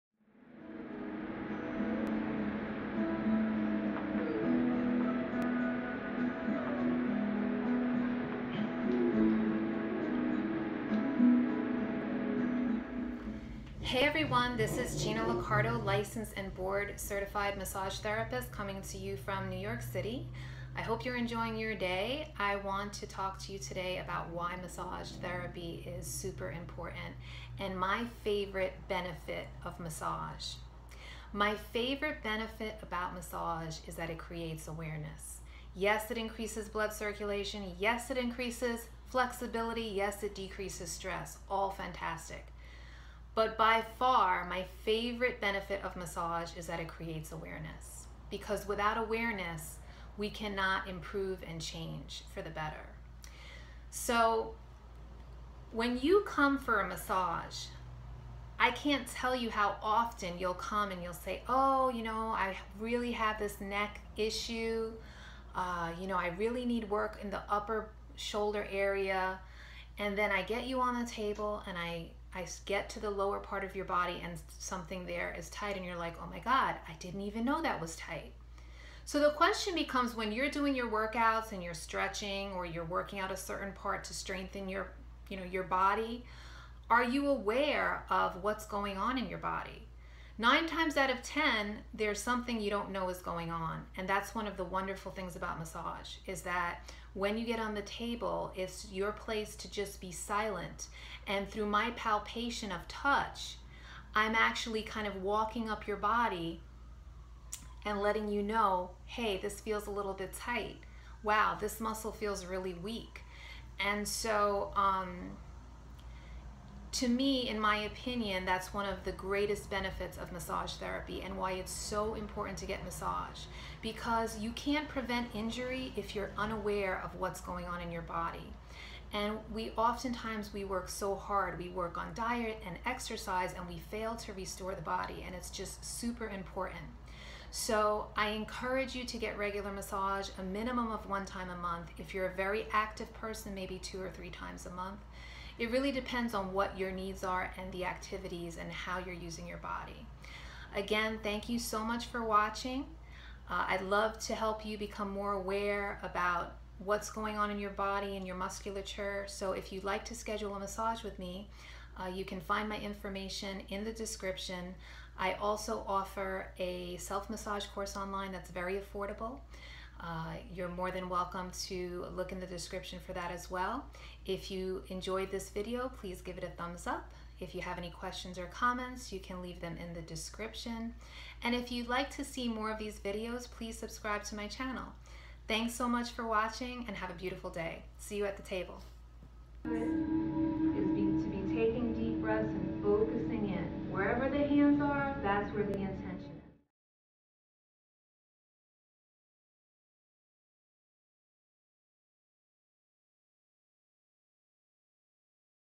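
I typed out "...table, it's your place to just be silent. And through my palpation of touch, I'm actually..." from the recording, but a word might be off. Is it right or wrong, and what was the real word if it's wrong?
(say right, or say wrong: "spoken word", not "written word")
right.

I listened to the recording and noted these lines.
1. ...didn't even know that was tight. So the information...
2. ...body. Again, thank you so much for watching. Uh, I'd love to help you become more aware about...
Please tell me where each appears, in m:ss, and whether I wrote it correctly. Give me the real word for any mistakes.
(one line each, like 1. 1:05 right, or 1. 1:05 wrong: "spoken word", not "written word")
1. 1:16 wrong: "question", not "information"
2. 2:29 right.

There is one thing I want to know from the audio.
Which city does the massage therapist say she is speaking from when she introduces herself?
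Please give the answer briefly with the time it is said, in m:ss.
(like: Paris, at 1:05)
New York City, at 0:19.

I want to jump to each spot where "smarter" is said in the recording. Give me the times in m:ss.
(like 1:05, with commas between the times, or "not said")
not said.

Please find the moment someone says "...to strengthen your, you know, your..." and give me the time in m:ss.
1:24.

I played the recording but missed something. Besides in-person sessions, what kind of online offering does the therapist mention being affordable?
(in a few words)
Self-massage course.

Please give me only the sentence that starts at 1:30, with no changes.
Nine times out of 10, there's something you don't know is going on.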